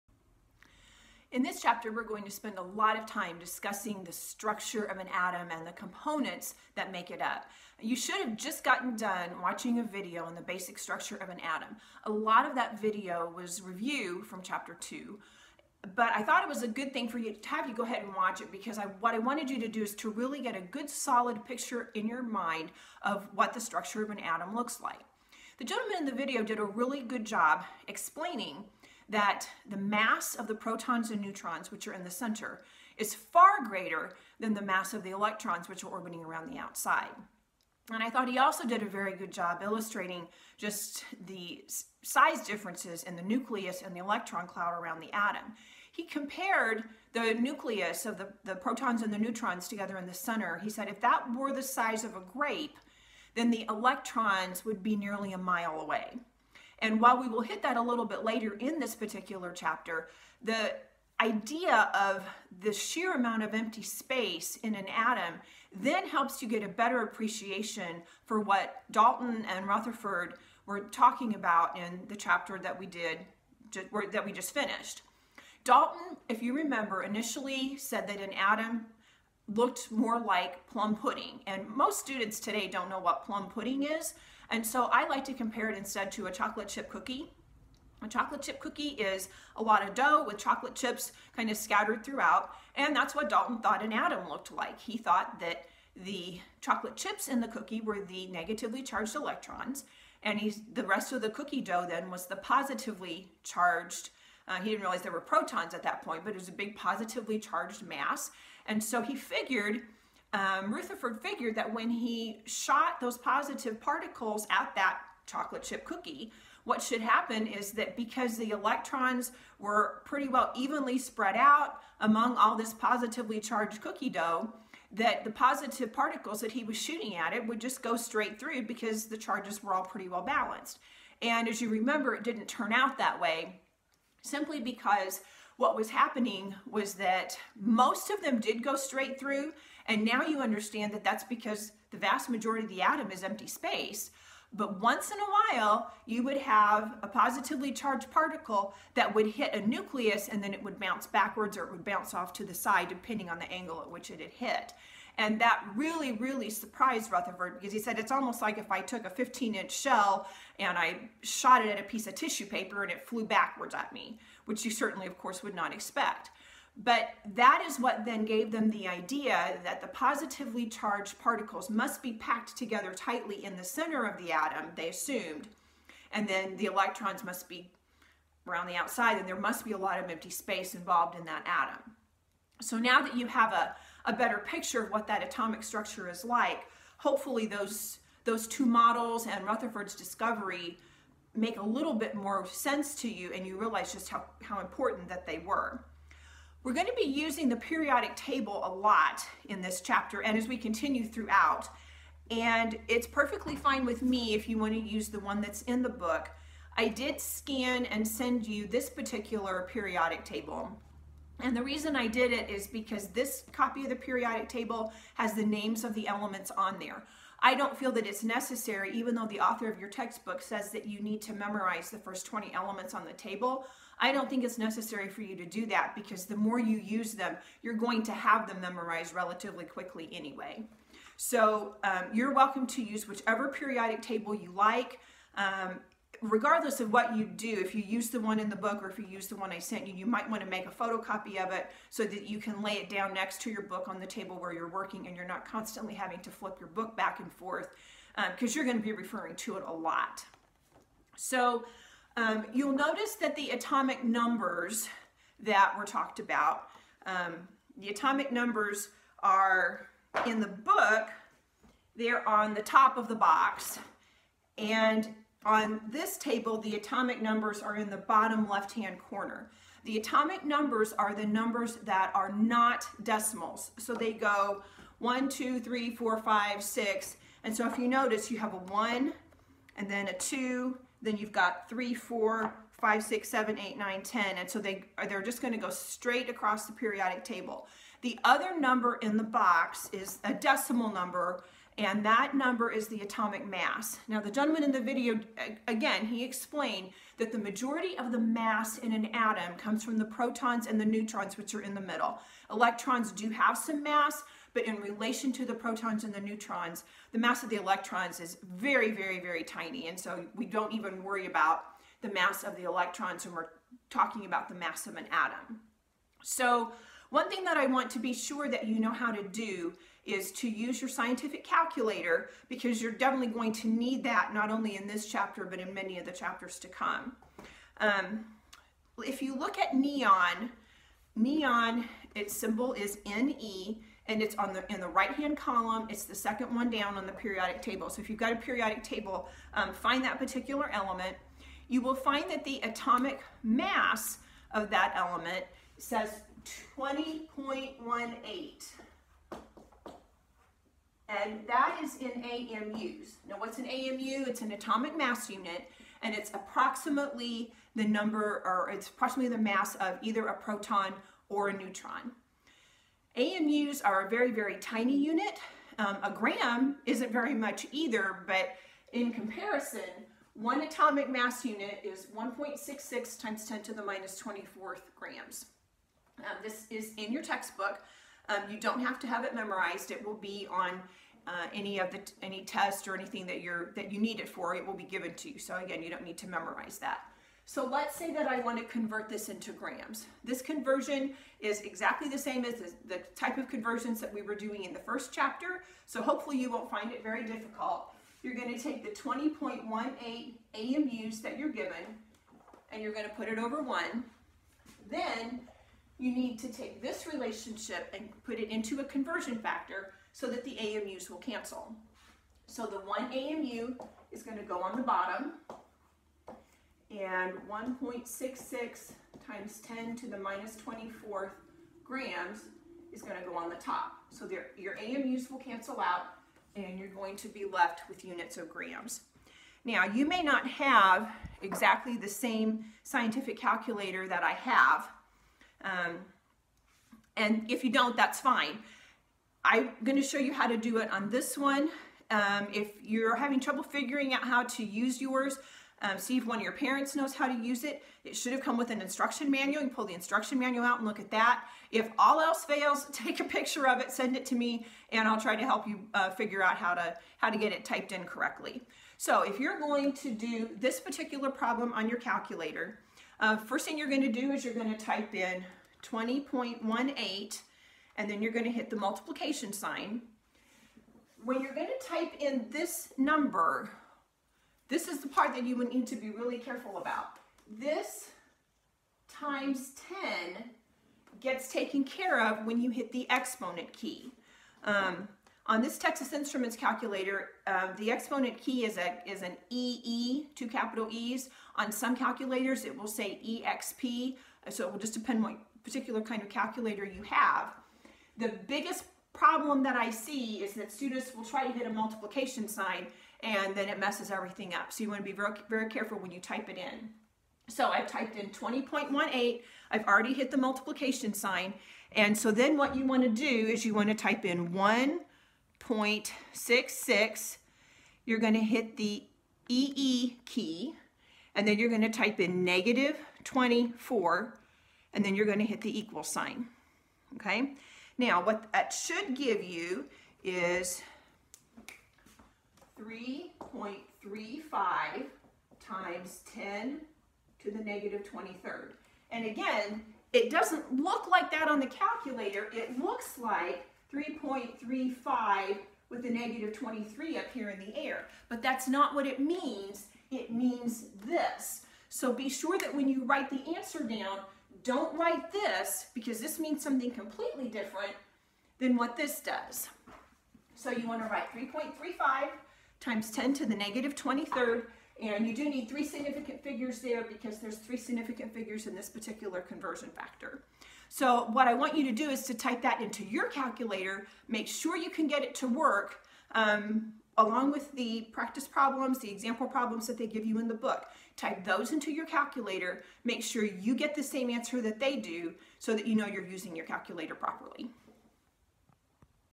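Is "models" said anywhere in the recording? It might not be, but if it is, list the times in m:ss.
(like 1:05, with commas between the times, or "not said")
3:08.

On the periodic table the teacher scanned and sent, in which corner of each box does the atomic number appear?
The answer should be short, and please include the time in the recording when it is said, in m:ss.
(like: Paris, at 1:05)
bottom left-hand corner, at 4:27.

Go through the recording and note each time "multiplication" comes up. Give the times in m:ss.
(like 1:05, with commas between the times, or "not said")
7:48, 8:21, 8:30.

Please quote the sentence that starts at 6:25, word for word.
So again, you don't need to memorize that.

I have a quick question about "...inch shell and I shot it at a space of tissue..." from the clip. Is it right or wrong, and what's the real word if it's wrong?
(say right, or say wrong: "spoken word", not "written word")
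wrong: "piece", not "space".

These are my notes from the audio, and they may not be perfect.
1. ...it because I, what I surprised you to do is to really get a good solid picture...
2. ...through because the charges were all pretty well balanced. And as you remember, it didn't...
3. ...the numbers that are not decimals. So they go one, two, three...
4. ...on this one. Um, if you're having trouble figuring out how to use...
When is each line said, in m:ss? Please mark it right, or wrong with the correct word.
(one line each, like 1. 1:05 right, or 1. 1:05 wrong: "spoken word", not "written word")
1. 0:18 wrong: "wanted", not "surprised"
2. 2:08 right
3. 4:31 right
4. 7:20 right.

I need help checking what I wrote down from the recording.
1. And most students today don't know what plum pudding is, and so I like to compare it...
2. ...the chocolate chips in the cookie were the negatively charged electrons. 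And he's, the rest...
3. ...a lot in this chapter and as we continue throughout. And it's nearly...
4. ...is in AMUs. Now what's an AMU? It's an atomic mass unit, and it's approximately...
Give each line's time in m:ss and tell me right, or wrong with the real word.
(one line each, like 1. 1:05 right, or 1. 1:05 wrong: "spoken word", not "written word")
1. 1:21 right
2. 1:35 right
3. 3:18 wrong: "perfectly", not "nearly"
4. 5:51 right.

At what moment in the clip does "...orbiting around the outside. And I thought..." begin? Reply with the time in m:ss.
0:35.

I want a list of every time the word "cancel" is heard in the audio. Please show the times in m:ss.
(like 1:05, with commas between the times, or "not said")
6:51, 7:05.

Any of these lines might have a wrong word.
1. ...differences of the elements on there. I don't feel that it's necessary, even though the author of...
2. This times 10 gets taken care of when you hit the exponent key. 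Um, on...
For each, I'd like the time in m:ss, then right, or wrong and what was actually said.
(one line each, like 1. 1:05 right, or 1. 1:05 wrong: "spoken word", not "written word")
1. 3:35 wrong: "names", not "differences"
2. 7:57 right.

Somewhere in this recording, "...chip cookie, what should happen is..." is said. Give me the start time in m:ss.
1:55.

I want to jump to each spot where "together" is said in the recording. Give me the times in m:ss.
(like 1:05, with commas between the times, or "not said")
0:49, 2:52.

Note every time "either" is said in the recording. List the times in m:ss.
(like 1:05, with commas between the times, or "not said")
6:00, 6:07.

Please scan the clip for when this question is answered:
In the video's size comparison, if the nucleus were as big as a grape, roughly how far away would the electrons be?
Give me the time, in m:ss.
0:54.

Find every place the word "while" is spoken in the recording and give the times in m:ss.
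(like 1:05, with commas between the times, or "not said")
0:56, 2:25.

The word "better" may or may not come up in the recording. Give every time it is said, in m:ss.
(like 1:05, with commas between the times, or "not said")
1:06, 3:04.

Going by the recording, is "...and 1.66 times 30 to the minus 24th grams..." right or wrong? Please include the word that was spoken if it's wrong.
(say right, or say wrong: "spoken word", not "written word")
wrong: "10", not "30".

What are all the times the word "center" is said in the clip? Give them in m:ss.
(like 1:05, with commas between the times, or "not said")
0:32, 0:50, 2:53.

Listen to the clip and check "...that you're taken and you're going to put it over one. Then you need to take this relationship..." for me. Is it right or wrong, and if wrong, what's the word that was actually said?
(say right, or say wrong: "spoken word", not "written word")
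wrong: "given", not "taken".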